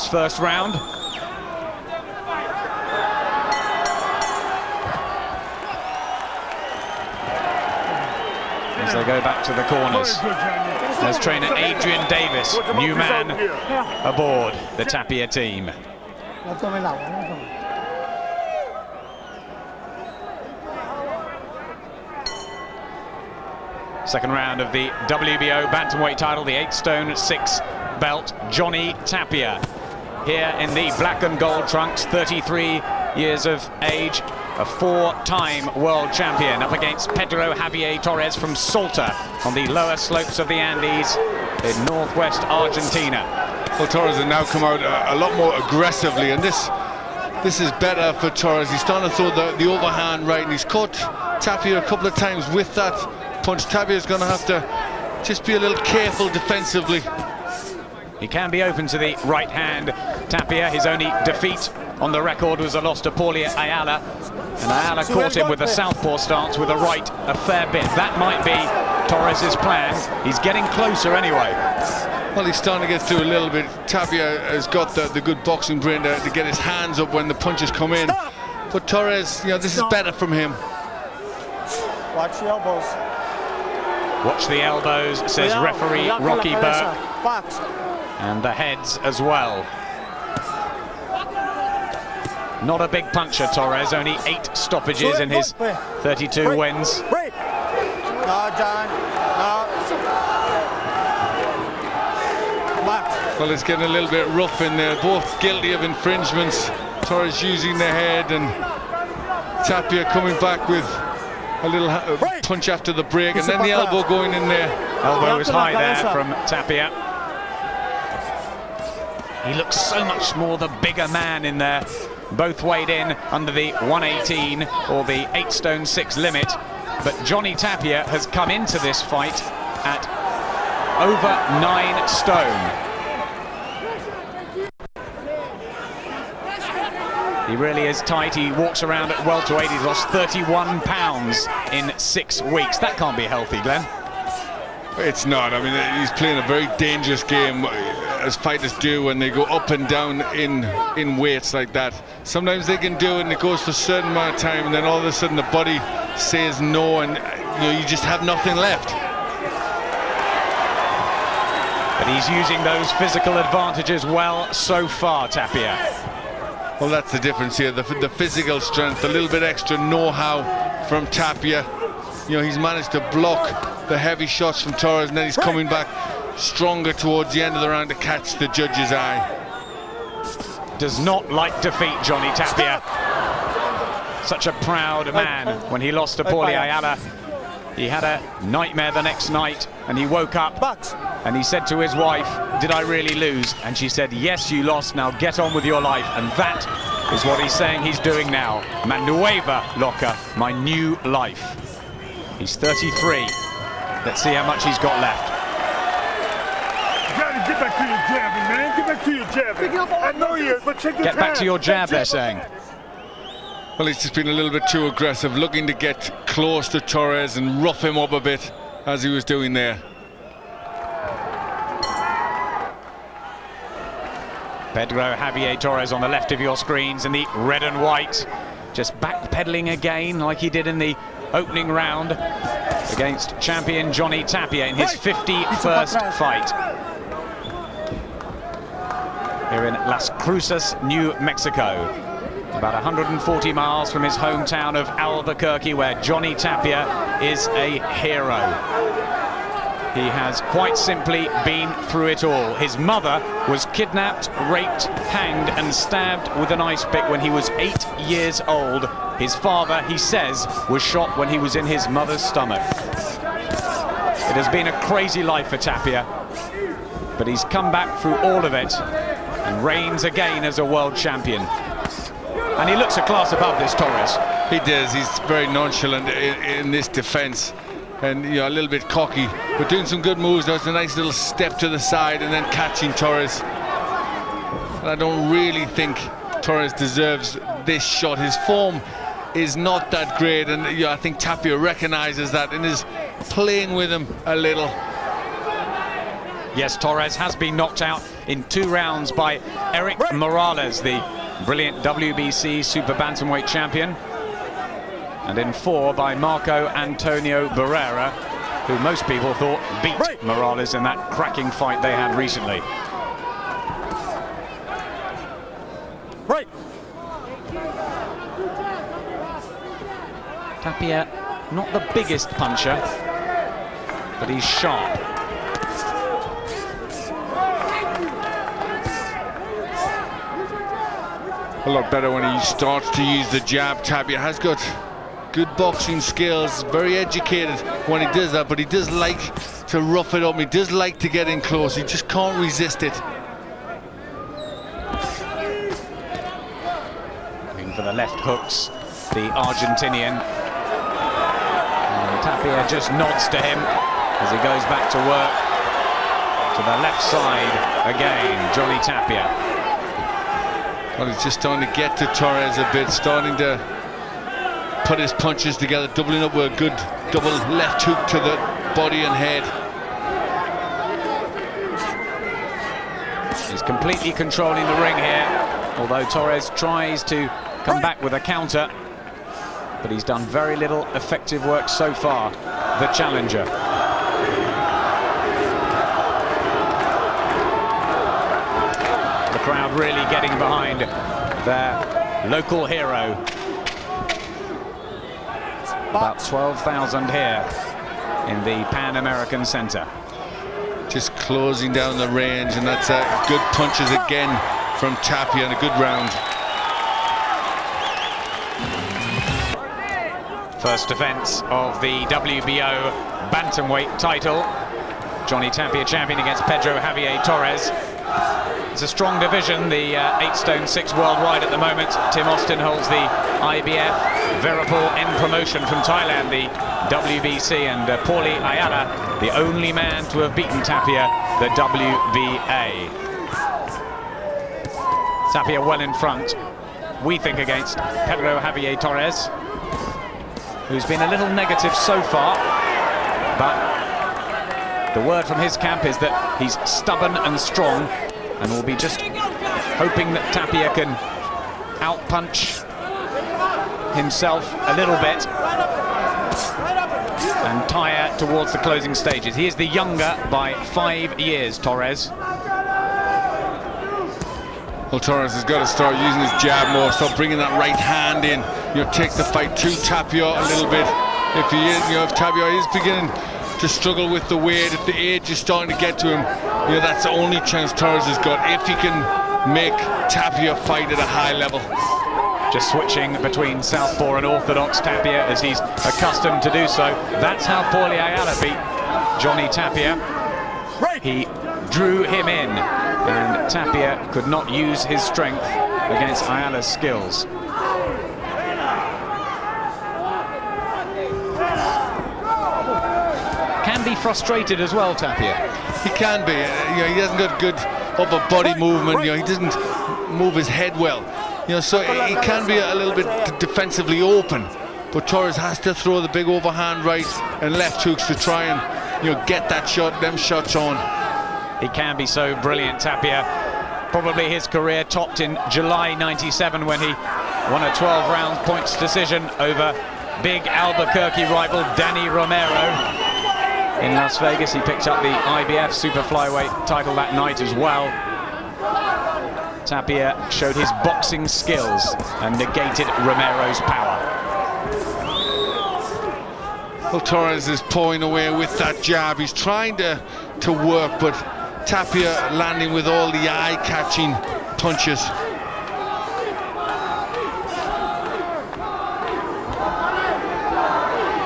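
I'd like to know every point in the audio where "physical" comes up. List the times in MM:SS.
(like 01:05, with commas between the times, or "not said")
02:42, 02:48.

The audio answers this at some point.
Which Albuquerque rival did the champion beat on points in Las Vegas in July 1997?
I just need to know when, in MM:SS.
08:51.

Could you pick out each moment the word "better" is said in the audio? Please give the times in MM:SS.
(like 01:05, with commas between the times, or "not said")
00:47, 01:19, 05:31.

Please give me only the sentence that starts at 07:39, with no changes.
He is the younger by five years, Torres.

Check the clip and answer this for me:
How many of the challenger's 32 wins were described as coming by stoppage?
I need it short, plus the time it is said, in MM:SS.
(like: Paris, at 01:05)
8, at 01:34.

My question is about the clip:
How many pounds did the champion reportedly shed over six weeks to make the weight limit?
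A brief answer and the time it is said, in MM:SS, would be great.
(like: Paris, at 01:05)
31, at 02:20.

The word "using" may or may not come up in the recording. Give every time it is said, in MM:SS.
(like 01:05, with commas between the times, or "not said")
01:47, 02:42, 07:45.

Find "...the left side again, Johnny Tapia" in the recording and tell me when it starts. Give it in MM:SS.
05:56.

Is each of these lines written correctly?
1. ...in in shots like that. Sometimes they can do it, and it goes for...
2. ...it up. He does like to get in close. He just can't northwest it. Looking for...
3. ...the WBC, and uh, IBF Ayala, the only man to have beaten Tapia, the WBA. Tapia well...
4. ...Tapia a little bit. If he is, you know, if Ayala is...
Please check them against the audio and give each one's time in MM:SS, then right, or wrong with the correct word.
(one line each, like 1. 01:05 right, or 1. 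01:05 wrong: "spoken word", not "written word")
1. 02:30 wrong: "weights", not "shots"
2. 05:40 wrong: "resist", not "northwest"
3. 07:06 wrong: "Paulie", not "IBF"
4. 07:49 wrong: "Tapia", not "Ayala".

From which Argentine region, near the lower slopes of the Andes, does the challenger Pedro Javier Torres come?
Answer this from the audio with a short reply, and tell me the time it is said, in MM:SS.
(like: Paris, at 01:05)
Salta, at 00:38.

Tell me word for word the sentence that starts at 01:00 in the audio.
Tapia, his only defeat on the record was a loss to Paulie Ayala.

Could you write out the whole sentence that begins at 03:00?
Does not like defeat, Johnny Tapia.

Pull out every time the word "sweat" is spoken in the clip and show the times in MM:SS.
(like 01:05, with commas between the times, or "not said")
not said.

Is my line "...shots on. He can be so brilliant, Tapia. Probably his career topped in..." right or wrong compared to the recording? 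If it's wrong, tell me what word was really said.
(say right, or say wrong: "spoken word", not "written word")
right.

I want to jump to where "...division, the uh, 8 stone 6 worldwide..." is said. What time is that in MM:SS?
06:59.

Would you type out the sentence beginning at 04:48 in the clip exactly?
His form is not that great, and you know, I think Tapia recognises that and is playing with him a little.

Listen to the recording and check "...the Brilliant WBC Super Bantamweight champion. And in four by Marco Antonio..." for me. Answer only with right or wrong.
right.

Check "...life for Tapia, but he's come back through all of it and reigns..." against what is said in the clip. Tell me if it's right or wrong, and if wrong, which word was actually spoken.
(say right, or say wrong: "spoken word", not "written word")
right.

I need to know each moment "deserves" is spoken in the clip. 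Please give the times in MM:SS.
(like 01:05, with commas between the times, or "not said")
04:46.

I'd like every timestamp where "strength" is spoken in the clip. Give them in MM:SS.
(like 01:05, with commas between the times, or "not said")
02:48, 08:15.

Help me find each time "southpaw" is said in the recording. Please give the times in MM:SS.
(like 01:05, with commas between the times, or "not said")
01:05, 08:03.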